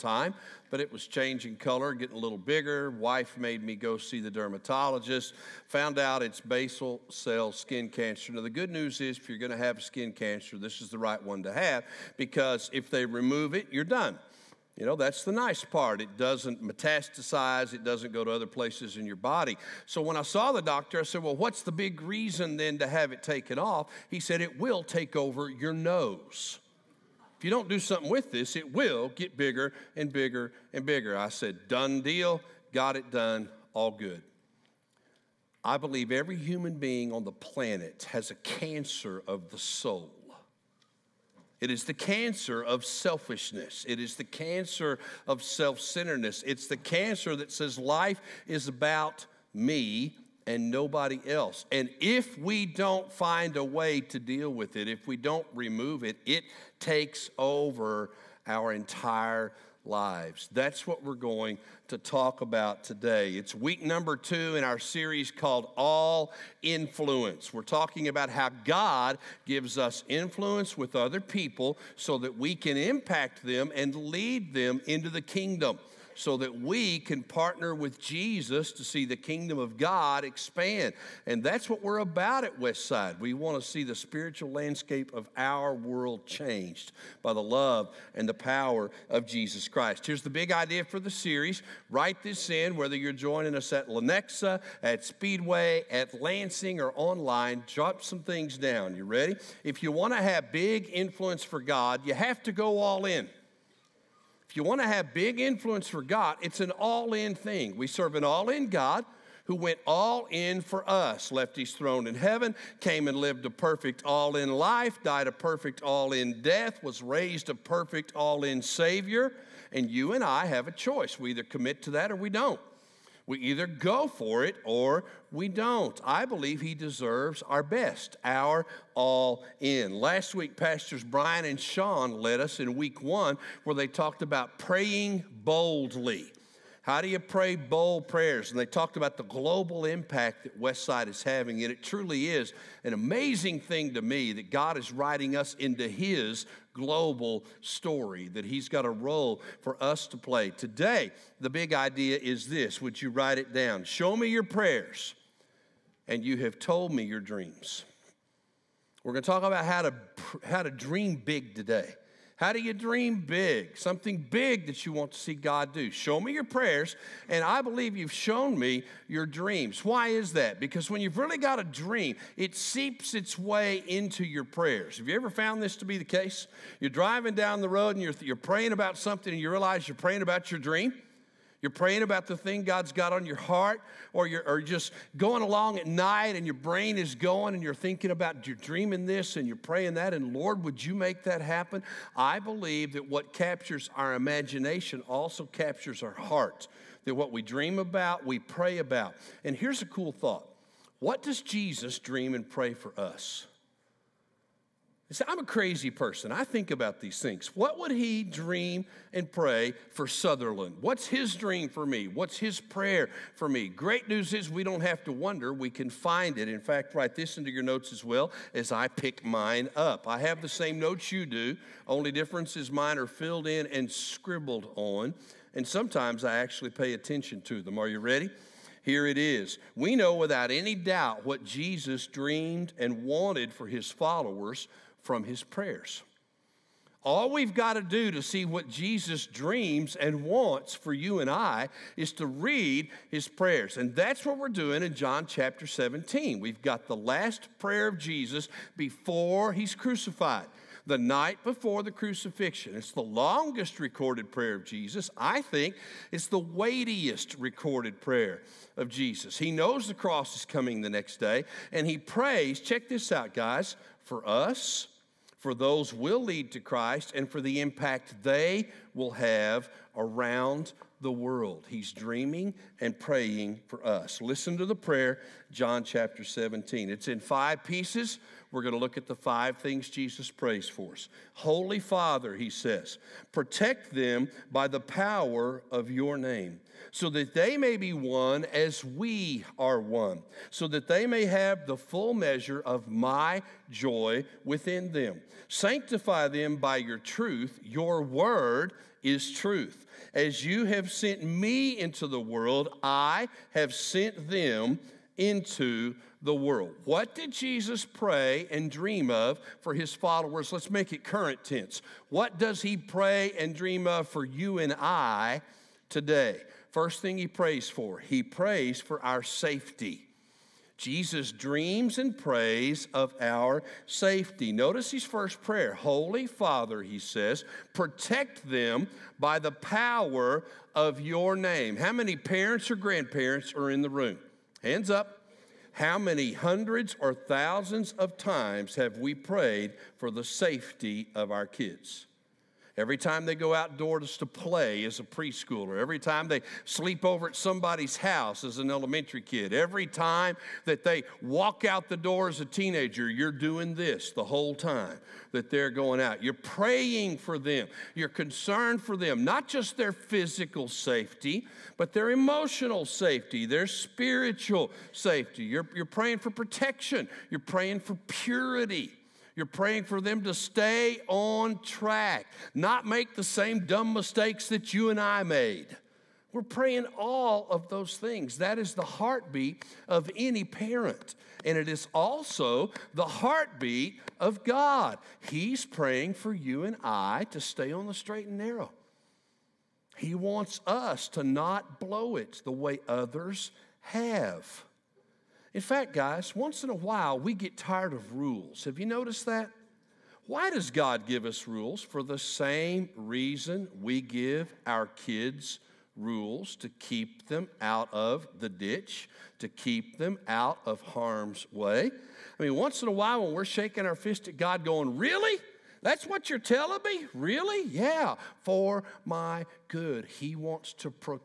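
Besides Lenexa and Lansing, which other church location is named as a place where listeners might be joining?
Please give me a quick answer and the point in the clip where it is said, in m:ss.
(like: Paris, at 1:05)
Speedway, at 1:35.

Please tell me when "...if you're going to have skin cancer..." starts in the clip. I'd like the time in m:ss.
0:09.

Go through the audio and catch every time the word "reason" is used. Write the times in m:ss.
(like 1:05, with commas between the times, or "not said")
0:22, 6:42.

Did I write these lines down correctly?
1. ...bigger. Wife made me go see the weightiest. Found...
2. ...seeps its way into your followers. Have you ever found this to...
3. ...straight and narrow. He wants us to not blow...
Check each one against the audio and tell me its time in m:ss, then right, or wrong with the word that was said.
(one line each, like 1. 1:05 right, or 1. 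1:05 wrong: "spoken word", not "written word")
1. 0:02 wrong: "dermatologist", not "weightiest"
2. 2:52 wrong: "prayers", not "followers"
3. 6:27 right.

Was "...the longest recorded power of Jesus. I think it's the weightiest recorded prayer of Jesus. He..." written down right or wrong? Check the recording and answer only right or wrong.
wrong.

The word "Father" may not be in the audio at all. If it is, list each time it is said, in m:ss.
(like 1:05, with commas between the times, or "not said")
4:41, 5:26.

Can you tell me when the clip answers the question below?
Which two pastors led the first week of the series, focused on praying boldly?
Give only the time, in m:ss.
2:11.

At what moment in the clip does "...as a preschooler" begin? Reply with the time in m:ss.
5:44.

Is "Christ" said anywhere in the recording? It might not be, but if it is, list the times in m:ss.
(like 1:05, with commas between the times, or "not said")
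1:29, 4:26.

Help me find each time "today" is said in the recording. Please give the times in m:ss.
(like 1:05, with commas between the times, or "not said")
1:02, 2:30, 2:41, 5:15.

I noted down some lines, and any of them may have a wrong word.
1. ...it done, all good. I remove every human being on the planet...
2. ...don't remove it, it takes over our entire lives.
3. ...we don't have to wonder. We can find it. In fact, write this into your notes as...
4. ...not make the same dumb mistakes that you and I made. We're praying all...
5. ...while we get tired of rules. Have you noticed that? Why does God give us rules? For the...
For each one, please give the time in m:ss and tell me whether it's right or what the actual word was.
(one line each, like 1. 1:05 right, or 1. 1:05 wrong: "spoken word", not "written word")
1. 0:32 wrong: "believe", not "remove"
2. 0:55 right
3. 3:34 right
4. 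6:12 right
5. 6:36 right.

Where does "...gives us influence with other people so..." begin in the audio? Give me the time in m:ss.
1:09.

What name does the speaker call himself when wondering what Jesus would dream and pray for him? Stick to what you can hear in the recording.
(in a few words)
Southerland.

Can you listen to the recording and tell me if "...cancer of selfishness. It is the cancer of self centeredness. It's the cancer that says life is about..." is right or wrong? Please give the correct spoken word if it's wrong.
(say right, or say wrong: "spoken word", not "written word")
right.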